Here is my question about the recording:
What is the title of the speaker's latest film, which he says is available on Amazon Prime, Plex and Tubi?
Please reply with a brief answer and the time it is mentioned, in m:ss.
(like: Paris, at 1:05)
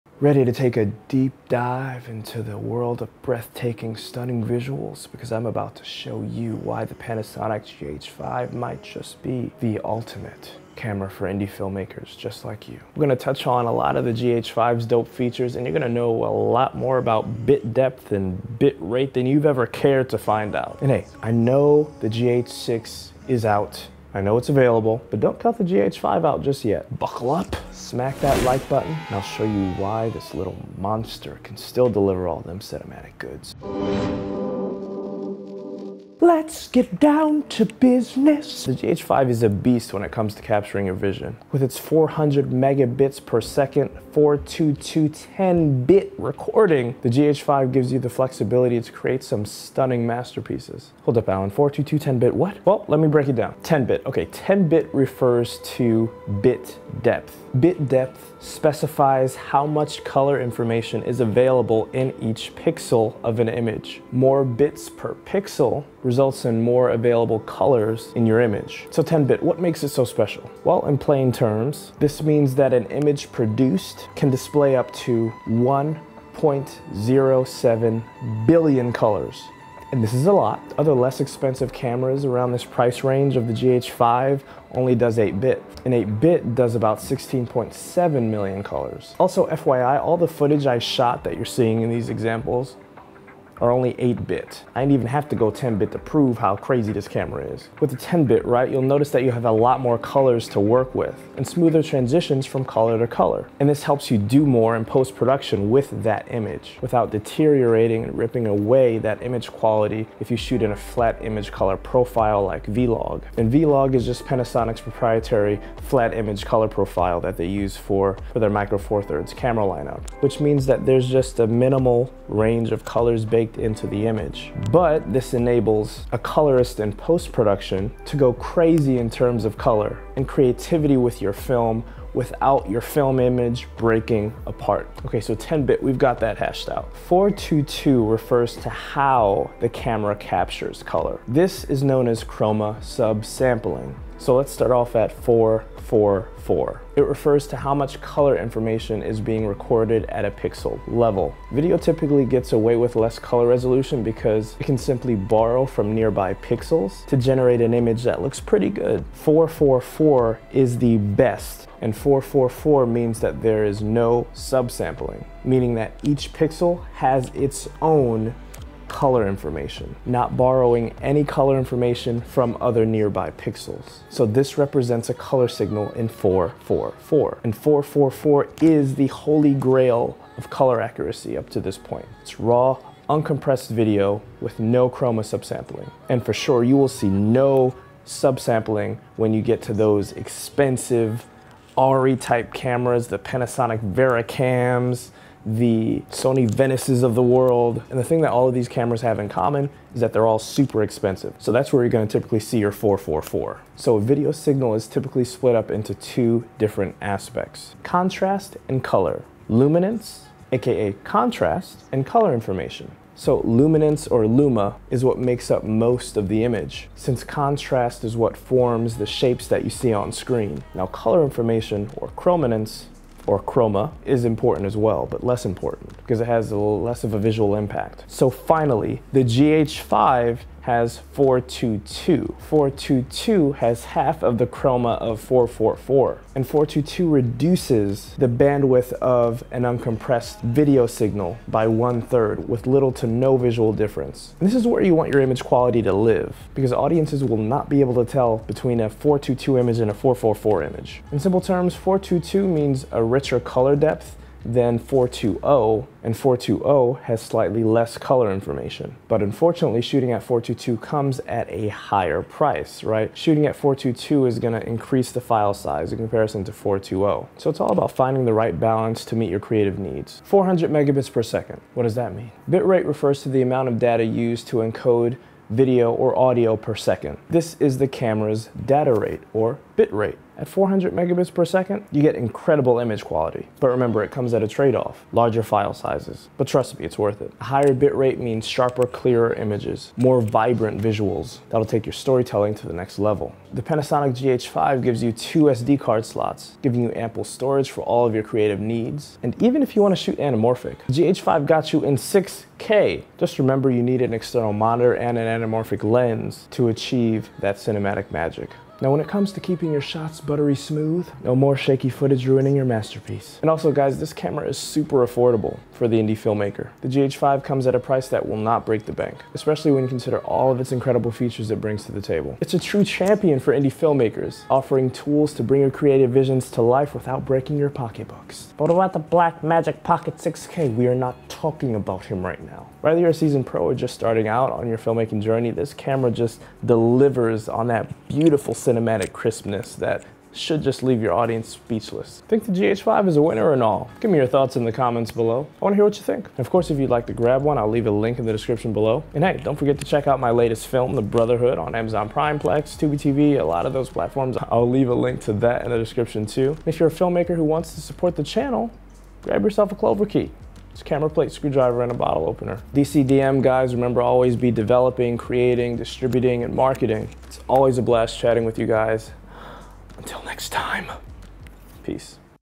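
The Brotherhood, at 5:50.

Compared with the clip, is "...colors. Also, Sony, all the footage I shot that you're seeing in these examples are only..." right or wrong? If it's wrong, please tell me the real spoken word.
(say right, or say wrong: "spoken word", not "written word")
wrong: "FYI", not "Sony".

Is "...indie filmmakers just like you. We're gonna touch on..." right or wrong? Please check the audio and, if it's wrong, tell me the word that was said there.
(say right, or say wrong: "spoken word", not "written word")
right.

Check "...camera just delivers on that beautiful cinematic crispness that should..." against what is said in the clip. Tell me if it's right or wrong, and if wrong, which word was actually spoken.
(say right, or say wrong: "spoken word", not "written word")
right.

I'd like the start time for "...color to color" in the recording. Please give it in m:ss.
1:42.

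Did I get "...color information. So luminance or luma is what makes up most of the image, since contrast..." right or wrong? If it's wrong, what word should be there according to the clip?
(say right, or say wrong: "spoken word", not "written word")
right.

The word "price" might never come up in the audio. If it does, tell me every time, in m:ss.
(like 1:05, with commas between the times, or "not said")
1:22, 4:22, 5:17.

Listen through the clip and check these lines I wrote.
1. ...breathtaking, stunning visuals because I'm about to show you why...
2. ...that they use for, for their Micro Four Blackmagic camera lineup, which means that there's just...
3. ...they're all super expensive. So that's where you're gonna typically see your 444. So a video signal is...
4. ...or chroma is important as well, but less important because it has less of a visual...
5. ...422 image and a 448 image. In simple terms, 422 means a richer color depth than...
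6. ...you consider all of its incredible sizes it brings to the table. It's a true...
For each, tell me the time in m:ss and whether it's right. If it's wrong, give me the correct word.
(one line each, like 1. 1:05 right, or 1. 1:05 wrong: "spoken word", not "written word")
1. 0:03 right
2. 1:57 wrong: "Thirds", not "Blackmagic"
3. 3:20 right
4. 3:43 right
5. 4:08 wrong: "444", not "448"
6. 5:19 wrong: "features", not "sizes".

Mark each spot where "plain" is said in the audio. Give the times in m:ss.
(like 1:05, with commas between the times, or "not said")
1:10.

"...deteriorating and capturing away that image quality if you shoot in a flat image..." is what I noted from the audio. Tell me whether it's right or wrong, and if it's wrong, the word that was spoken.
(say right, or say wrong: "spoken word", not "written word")
wrong: "ripping", not "capturing".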